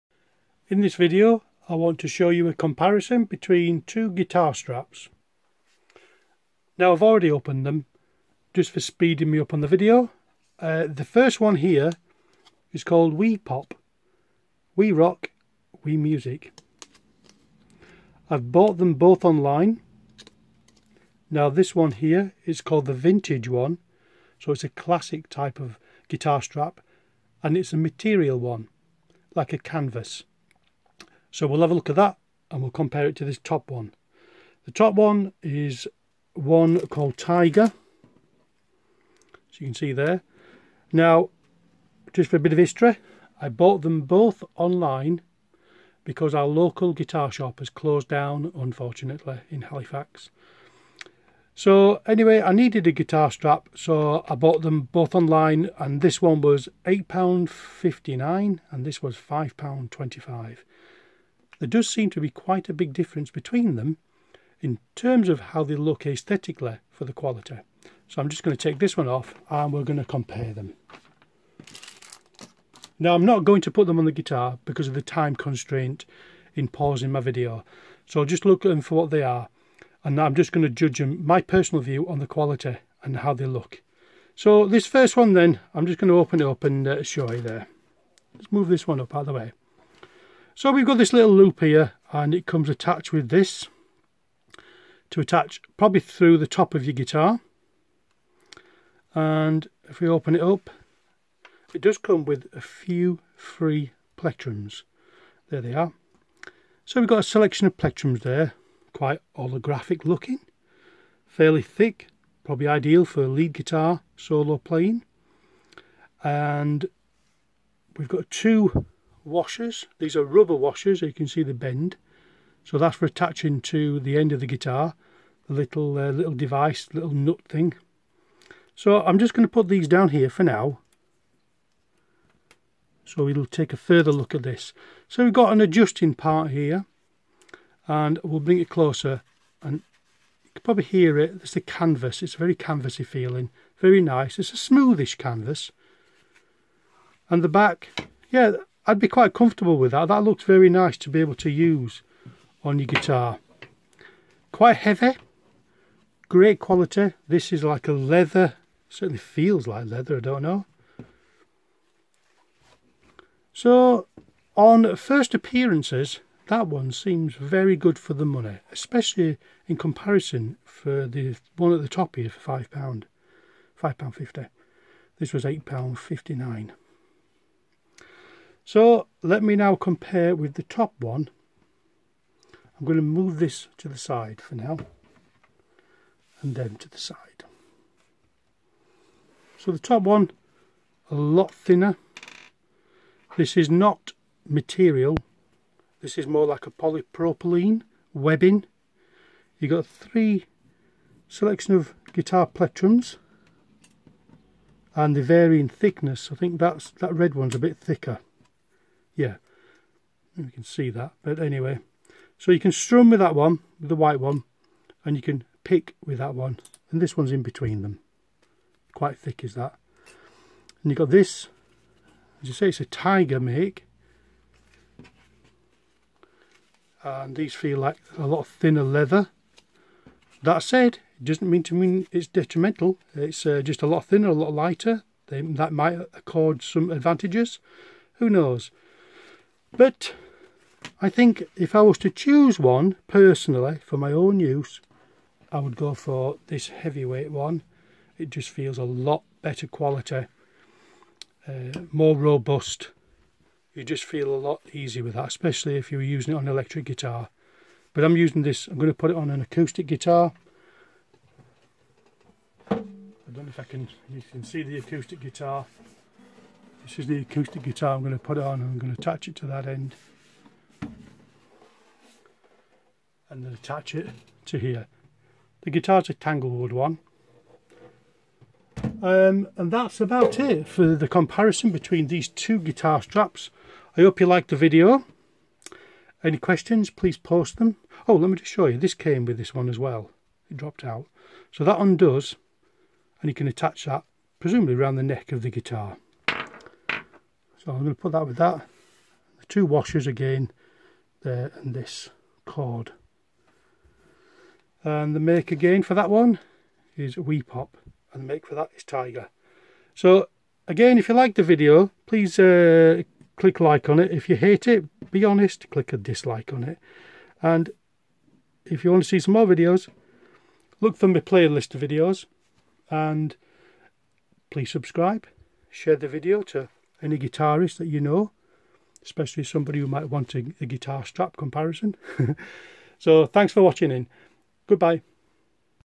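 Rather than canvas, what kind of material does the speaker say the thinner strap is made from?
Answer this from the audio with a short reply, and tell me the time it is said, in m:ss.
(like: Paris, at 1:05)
Polypropylene webbing, at 3:16.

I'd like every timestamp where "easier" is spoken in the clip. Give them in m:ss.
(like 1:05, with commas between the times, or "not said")
4:14.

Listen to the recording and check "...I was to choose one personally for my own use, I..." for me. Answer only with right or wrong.
right.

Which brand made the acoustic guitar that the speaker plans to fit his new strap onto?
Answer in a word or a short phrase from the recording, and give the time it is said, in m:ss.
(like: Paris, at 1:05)
Tanglewood, at 4:36.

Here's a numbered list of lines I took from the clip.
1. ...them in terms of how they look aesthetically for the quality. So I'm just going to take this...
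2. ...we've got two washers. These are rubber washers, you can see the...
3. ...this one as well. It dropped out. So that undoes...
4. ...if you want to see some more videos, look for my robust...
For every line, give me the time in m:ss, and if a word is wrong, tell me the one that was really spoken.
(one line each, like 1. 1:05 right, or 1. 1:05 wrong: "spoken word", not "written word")
1. 1:03 right
2. 1:57 right
3. 4:49 right
4. 5:18 wrong: "playlist", not "robust".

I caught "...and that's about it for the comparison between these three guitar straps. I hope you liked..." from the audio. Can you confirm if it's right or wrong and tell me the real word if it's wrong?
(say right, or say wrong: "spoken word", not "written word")
wrong: "two", not "three".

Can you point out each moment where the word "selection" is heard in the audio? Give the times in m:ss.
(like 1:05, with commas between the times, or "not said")
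1:47, 3:21.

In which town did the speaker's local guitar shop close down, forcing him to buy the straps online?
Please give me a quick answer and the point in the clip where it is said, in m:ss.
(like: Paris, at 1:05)
Halifax, at 0:49.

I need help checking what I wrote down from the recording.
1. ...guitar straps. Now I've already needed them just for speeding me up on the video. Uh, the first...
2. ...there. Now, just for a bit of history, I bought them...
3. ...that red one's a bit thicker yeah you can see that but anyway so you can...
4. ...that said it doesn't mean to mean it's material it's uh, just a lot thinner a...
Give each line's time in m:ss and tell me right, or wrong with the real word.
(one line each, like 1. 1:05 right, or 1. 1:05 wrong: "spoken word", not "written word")
1. 0:04 wrong: "opened", not "needed"
2. 0:39 right
3. 3:27 right
4. 3:50 wrong: "detrimental", not "material".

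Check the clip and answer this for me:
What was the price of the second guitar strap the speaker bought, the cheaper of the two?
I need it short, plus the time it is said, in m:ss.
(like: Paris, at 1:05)
£5.25, at 0:59.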